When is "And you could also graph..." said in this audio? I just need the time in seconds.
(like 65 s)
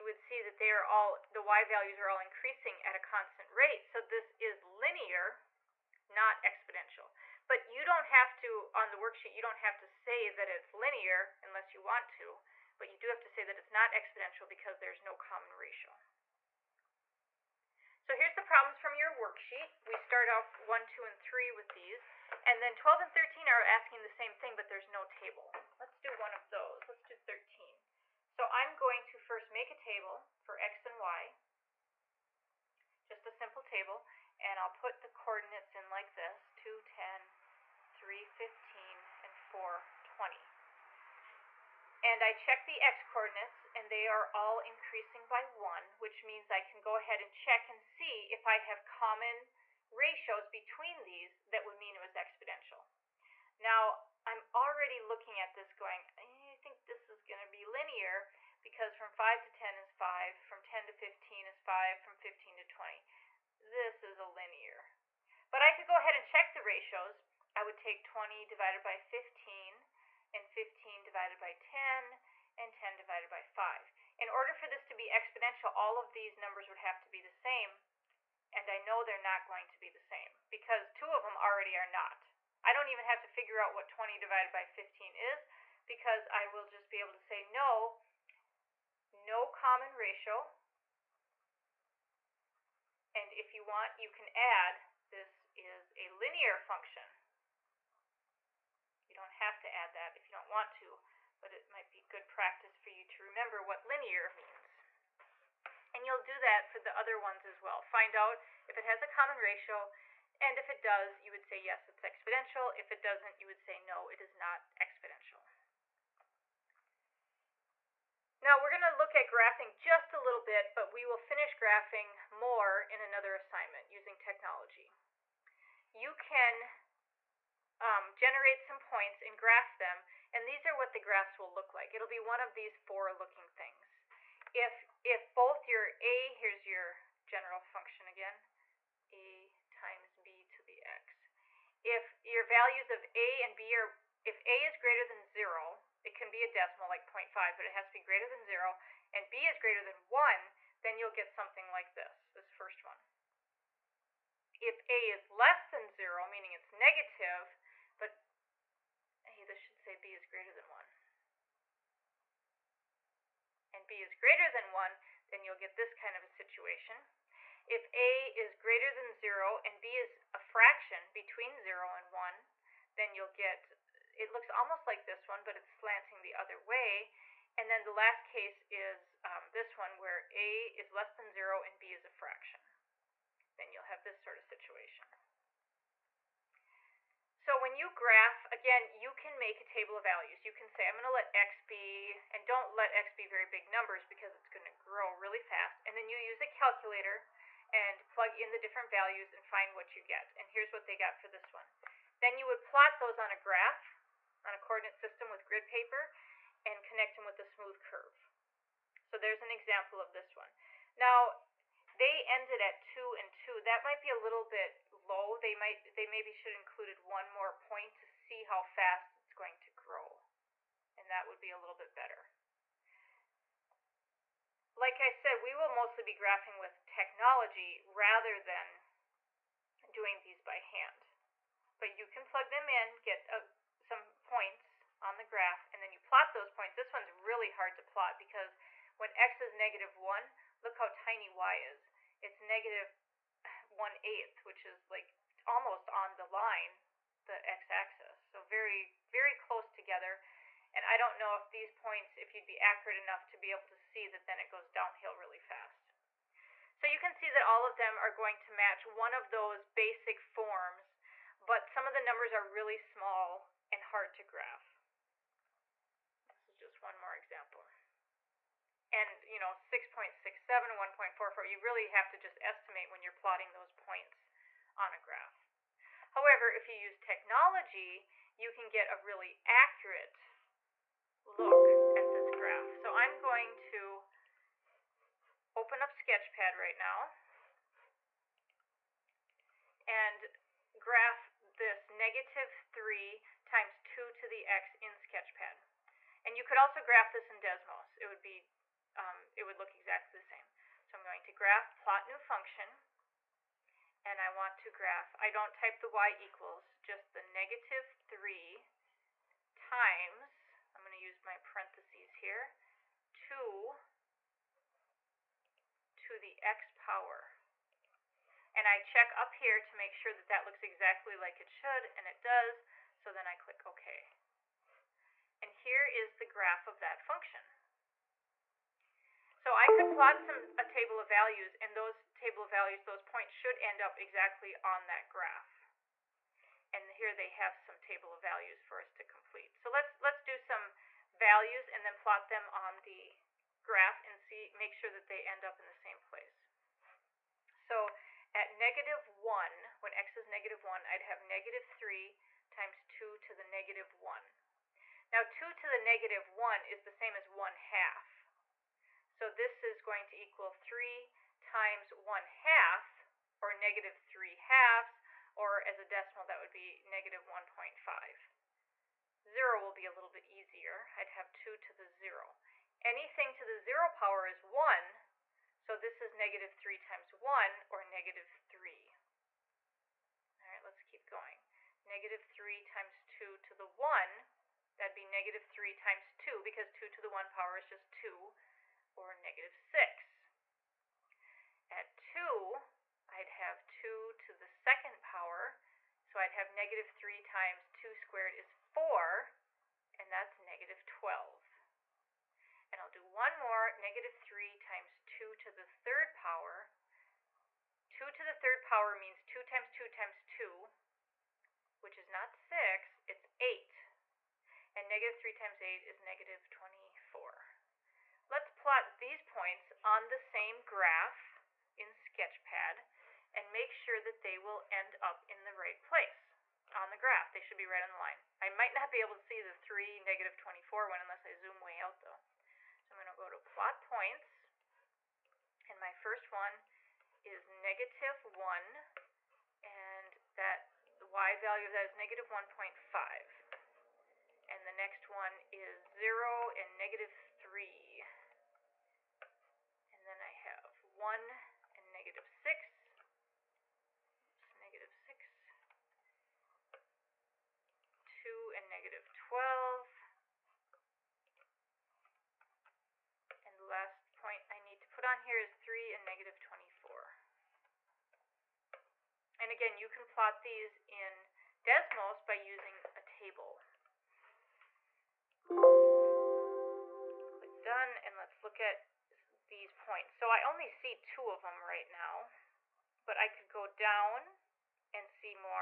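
296 s.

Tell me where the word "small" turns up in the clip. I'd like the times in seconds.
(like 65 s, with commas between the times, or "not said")
262 s.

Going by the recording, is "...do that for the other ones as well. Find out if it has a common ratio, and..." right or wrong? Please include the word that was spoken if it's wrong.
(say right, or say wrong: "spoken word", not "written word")
right.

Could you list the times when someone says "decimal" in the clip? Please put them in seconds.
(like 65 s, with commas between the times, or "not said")
146 s, 365 s.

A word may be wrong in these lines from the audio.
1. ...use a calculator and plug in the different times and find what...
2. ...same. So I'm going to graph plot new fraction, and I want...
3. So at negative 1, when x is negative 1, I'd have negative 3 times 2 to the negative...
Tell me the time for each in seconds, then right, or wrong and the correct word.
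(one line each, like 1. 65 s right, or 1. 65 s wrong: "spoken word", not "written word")
1. 196 s wrong: "values", not "times"
2. 300 s wrong: "function", not "fraction"
3. 347 s right.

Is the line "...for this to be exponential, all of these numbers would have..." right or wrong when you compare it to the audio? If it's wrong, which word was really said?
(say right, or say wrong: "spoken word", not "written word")
right.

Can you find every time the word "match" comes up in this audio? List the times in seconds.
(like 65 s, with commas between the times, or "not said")
258 s.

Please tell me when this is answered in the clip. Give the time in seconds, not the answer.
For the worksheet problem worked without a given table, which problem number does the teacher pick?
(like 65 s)
26 s.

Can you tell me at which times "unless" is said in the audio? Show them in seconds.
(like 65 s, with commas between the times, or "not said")
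11 s, 430 s.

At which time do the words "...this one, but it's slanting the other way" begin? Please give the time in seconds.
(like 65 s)
175 s.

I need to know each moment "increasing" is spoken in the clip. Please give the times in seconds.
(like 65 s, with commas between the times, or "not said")
2 s, 44 s.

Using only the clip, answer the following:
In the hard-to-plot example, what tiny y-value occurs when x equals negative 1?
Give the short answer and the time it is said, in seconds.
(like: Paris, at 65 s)
-1/8, at 242 s.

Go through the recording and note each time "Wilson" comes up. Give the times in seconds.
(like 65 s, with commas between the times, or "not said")
not said.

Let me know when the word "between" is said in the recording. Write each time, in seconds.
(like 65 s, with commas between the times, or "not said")
50 s, 171 s.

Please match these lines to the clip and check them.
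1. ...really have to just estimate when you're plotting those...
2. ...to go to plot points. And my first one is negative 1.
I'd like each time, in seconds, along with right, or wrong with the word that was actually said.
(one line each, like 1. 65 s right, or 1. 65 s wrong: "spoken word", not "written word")
1. 271 s right
2. 433 s right.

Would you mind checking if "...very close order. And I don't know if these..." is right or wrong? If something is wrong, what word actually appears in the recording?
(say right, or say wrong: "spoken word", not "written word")
wrong: "together", not "order".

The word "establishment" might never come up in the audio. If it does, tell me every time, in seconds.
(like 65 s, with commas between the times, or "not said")
not said.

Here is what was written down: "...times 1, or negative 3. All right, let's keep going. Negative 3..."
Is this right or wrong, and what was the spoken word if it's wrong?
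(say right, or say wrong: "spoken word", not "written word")
right.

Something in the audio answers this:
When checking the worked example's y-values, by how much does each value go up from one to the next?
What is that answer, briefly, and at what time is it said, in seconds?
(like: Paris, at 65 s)
5, at 60 s.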